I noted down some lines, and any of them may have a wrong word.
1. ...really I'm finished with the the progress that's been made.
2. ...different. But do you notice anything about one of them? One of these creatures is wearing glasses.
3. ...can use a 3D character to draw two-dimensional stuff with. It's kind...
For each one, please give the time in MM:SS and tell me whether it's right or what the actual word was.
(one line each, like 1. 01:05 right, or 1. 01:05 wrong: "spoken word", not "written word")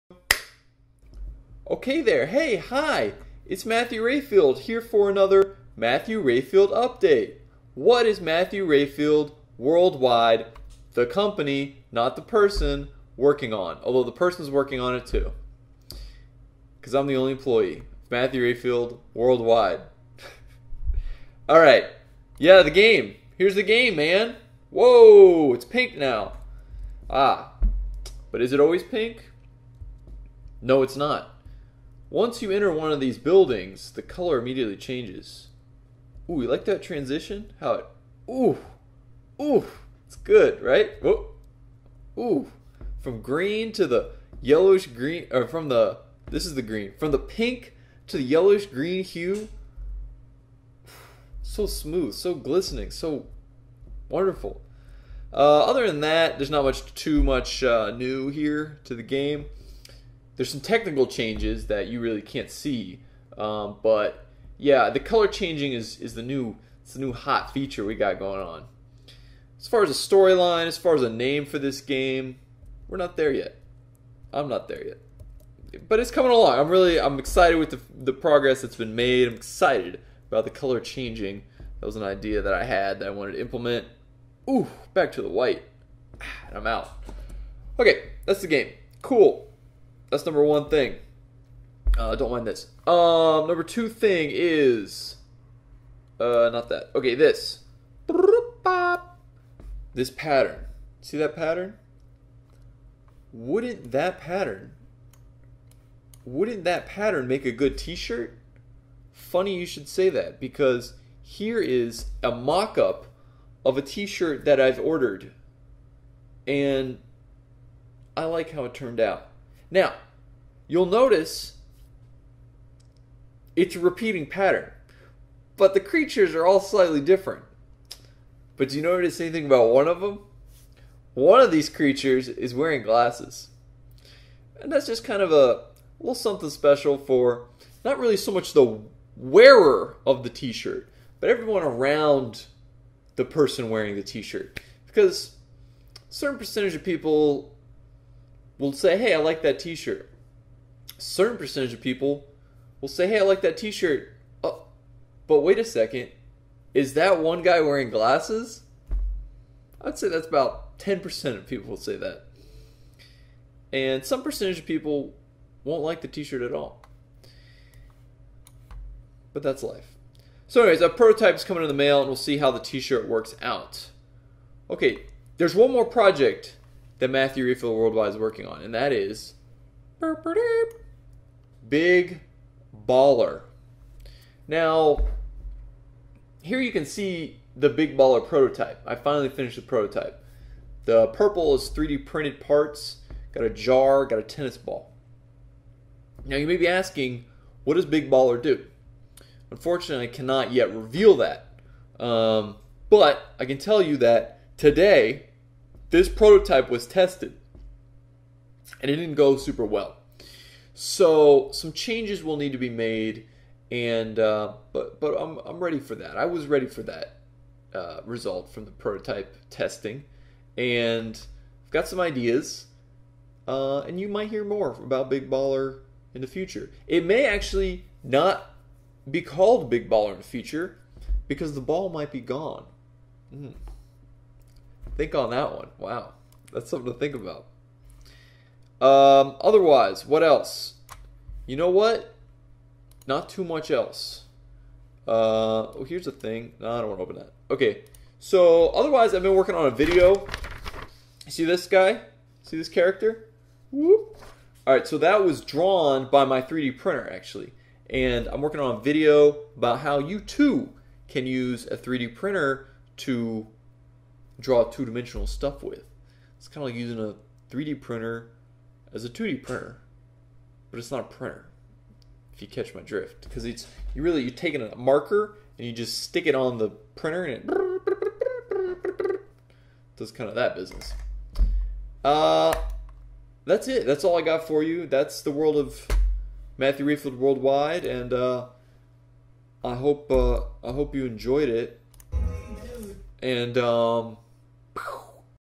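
1. 01:16 wrong: "excited", not "finished"
2. 02:06 right
3. 04:21 wrong: "printer", not "character".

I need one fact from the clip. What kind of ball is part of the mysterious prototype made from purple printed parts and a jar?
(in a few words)
tennis ball.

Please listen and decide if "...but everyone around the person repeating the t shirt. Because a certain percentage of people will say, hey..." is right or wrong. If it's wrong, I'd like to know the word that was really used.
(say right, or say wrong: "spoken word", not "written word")
wrong: "wearing", not "repeating".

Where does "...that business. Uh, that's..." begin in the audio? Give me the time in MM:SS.
04:40.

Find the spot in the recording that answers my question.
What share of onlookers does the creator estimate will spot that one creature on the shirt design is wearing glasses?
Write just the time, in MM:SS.
02:40.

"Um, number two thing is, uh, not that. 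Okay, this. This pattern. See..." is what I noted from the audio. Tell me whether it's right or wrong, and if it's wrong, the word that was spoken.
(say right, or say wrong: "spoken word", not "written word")
right.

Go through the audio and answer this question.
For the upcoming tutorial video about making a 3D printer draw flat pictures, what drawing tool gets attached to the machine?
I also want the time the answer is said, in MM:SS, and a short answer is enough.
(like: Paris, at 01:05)
marker, at 04:34.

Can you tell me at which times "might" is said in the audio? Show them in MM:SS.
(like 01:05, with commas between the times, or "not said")
03:44, 03:51.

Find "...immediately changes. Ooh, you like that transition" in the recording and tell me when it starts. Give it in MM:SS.
00:34.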